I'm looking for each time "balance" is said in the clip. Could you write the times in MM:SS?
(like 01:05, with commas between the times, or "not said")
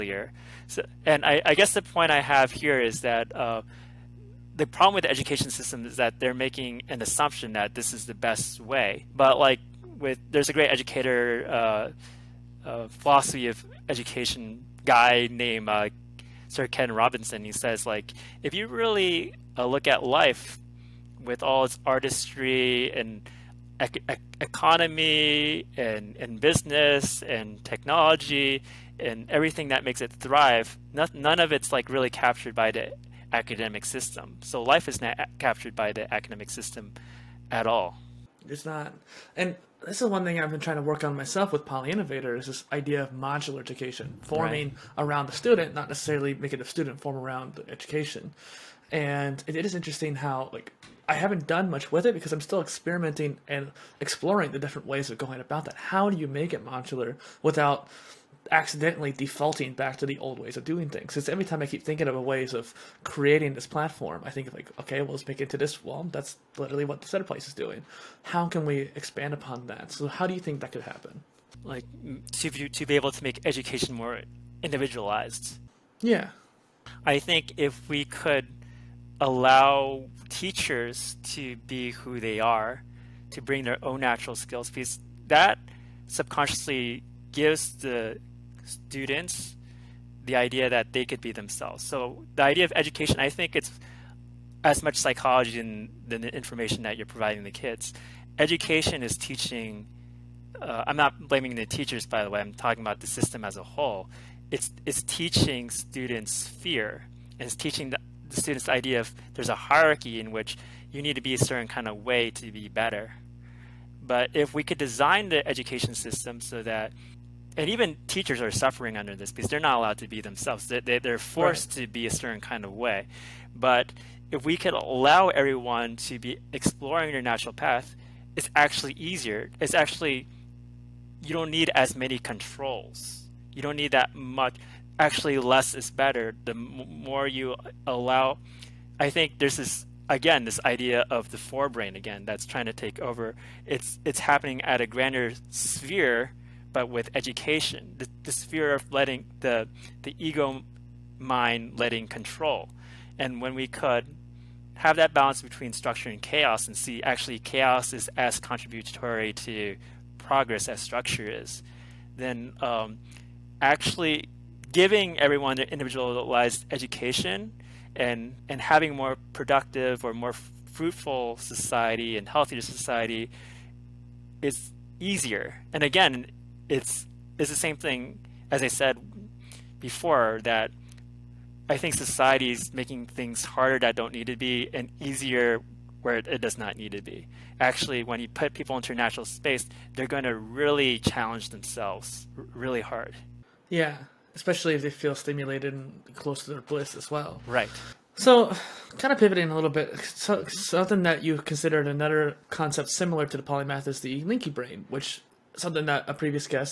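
02:35.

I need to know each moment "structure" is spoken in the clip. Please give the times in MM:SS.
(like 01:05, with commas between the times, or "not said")
02:35, 02:40.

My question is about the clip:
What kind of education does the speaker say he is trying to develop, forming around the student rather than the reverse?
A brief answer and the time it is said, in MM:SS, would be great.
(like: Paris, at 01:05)
modular education, at 00:43.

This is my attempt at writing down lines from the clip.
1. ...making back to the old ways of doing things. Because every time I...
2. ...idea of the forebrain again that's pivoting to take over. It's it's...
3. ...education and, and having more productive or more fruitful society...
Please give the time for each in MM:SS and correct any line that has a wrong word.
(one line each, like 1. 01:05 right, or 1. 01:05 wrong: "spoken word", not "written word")
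1. 00:59 wrong: "defaulting", not "making"
2. 02:20 wrong: "trying", not "pivoting"
3. 02:46 right.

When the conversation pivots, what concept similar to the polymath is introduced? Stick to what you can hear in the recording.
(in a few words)
linky brain.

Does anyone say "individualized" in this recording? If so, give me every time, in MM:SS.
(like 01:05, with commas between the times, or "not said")
01:14, 02:45.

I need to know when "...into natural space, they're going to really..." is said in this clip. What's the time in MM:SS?
03:08.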